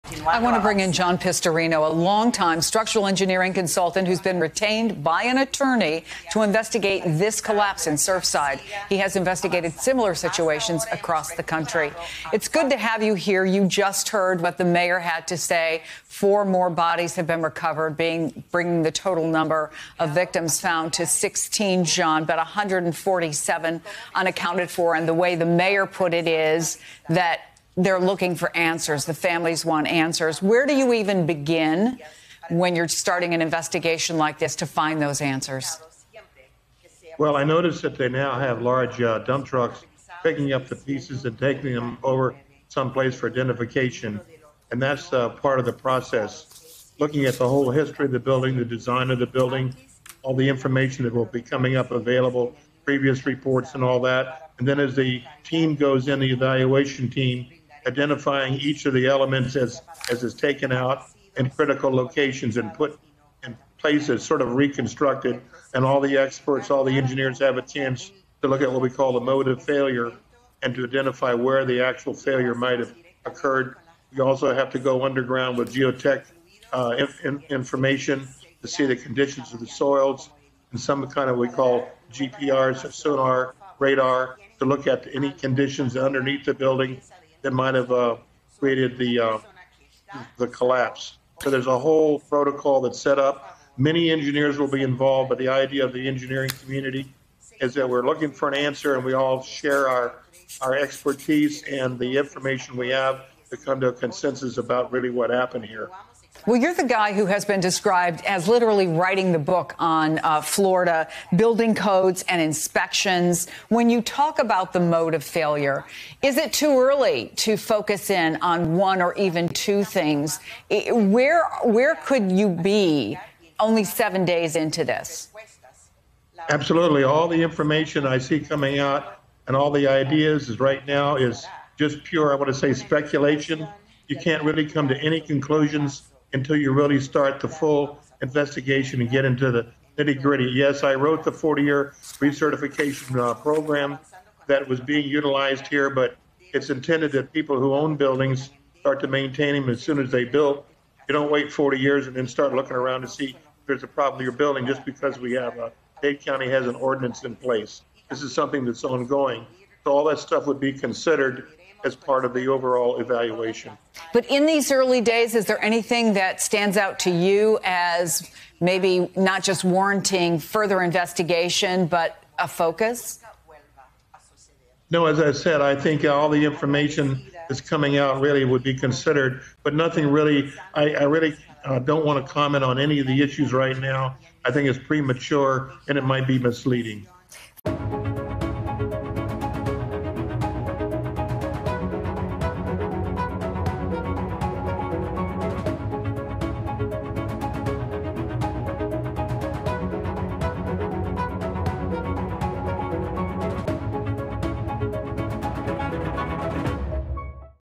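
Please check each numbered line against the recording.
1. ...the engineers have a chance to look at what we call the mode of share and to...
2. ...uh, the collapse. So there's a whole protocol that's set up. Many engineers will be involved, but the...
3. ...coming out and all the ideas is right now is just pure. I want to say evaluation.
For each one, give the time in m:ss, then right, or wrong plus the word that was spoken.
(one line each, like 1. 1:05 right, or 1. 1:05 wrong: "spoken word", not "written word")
1. 1:06 wrong: "failure", not "share"
2. 1:29 right
3. 2:08 wrong: "speculation", not "evaluation".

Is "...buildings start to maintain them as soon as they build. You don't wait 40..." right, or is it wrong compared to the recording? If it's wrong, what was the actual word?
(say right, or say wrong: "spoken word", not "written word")
right.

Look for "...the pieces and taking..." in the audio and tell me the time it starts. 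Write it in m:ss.
0:40.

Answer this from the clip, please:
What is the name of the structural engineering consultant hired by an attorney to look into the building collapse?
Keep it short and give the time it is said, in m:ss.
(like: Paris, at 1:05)
John Pistorino, at 0:00.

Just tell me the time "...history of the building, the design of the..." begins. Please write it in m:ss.
0:47.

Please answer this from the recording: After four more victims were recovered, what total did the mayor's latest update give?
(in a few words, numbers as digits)
16.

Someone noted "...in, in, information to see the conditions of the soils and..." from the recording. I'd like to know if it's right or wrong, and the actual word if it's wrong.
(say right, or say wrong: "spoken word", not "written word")
right.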